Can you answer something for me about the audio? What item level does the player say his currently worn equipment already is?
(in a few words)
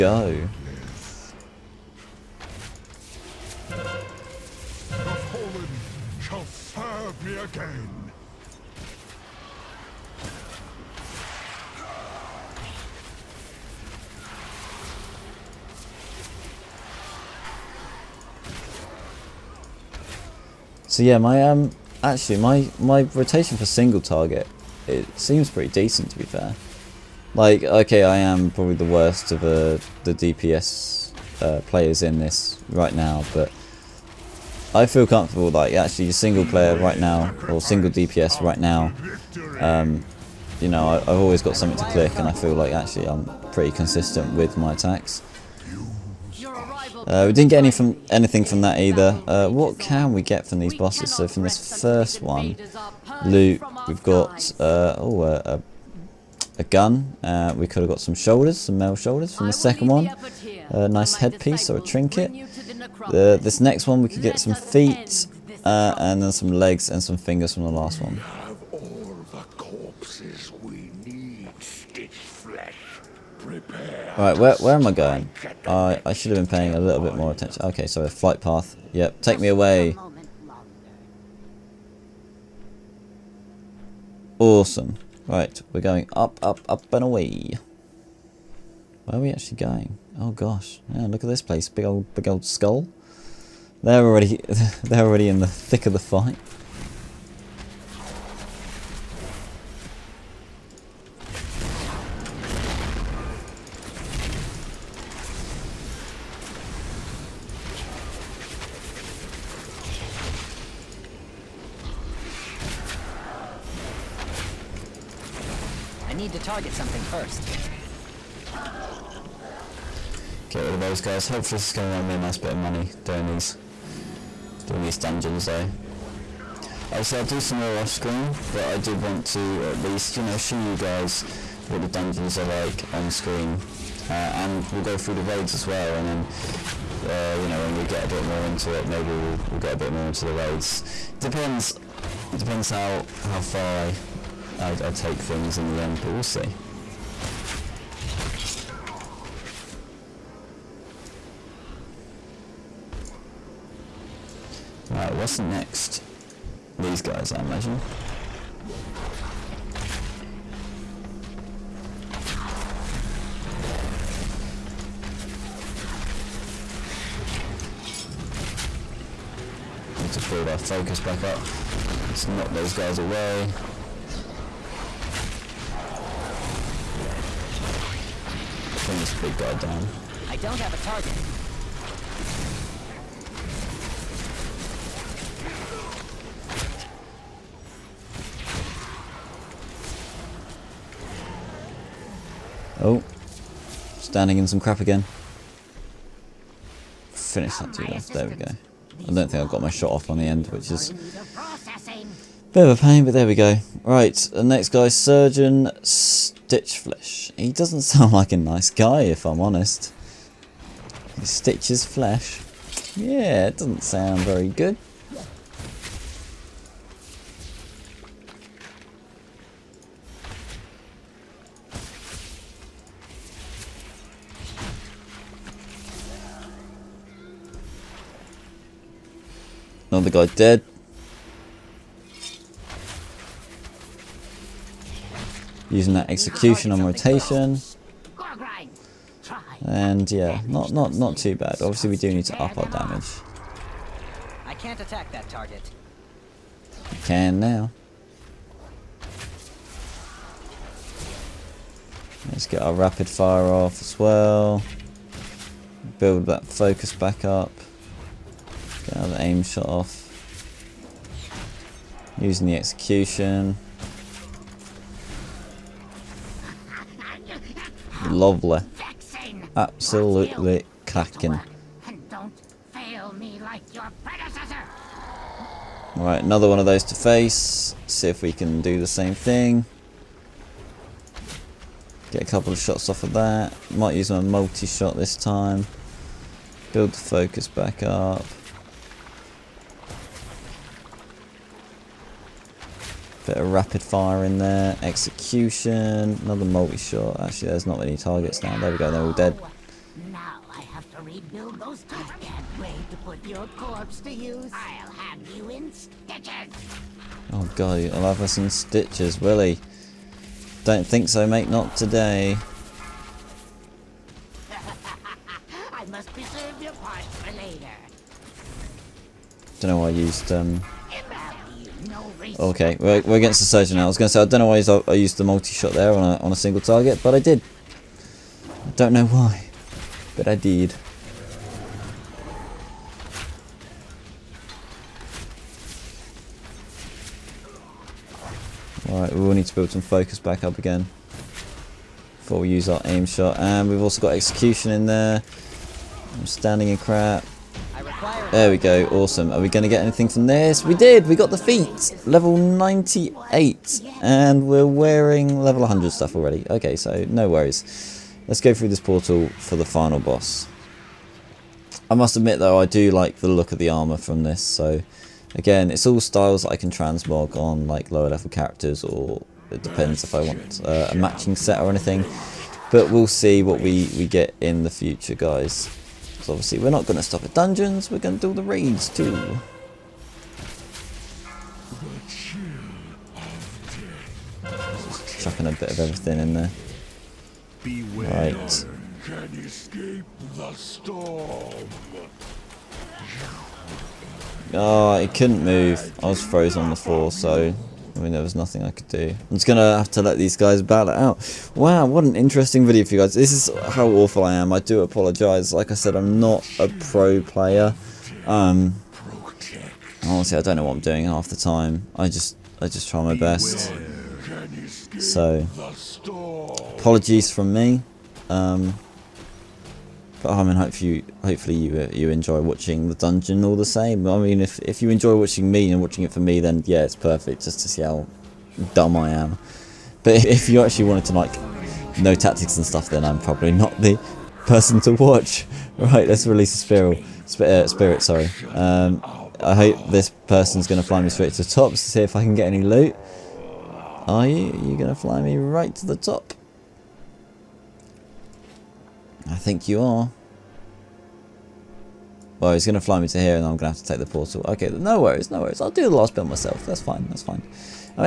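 100.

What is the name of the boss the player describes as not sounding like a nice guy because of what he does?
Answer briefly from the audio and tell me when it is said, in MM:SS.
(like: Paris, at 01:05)
Surgeon Stitchflesh, at 03:24.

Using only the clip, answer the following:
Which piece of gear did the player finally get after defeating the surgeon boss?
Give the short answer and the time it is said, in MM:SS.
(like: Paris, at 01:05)
The feet, at 05:51.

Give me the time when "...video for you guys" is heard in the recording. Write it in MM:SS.
06:42.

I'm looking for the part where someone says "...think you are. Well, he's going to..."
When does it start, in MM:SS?
07:29.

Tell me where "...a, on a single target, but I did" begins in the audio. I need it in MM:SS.
05:26.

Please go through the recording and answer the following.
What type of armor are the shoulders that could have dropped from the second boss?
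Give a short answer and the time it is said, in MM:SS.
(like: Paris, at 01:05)
Mail, at 00:58.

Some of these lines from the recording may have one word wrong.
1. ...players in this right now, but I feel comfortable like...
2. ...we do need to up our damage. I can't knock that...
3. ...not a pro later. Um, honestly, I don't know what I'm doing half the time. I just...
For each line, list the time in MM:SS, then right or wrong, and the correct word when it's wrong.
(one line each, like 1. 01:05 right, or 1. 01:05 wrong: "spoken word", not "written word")
1. 00:31 right
2. 04:01 wrong: "attack", not "knock"
3. 06:46 wrong: "player", not "later".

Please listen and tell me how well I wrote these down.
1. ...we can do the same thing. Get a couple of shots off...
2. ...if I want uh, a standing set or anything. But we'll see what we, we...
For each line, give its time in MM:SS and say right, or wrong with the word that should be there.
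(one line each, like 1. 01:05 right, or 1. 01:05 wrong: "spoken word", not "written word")
1. 04:38 right
2. 06:10 wrong: "matching", not "standing".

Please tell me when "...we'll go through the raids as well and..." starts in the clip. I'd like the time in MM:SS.
02:14.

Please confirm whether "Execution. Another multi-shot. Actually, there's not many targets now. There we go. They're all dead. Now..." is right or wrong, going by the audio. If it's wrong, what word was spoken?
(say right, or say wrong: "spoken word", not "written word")
right.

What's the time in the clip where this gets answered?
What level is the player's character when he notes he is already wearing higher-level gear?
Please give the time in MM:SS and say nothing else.
05:52.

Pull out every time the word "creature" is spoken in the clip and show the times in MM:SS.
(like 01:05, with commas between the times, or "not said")
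not said.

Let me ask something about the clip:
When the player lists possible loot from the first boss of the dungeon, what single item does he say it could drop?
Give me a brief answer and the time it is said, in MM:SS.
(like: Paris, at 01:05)
A gun, at 00:56.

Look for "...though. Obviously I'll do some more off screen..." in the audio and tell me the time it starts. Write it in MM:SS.
02:05.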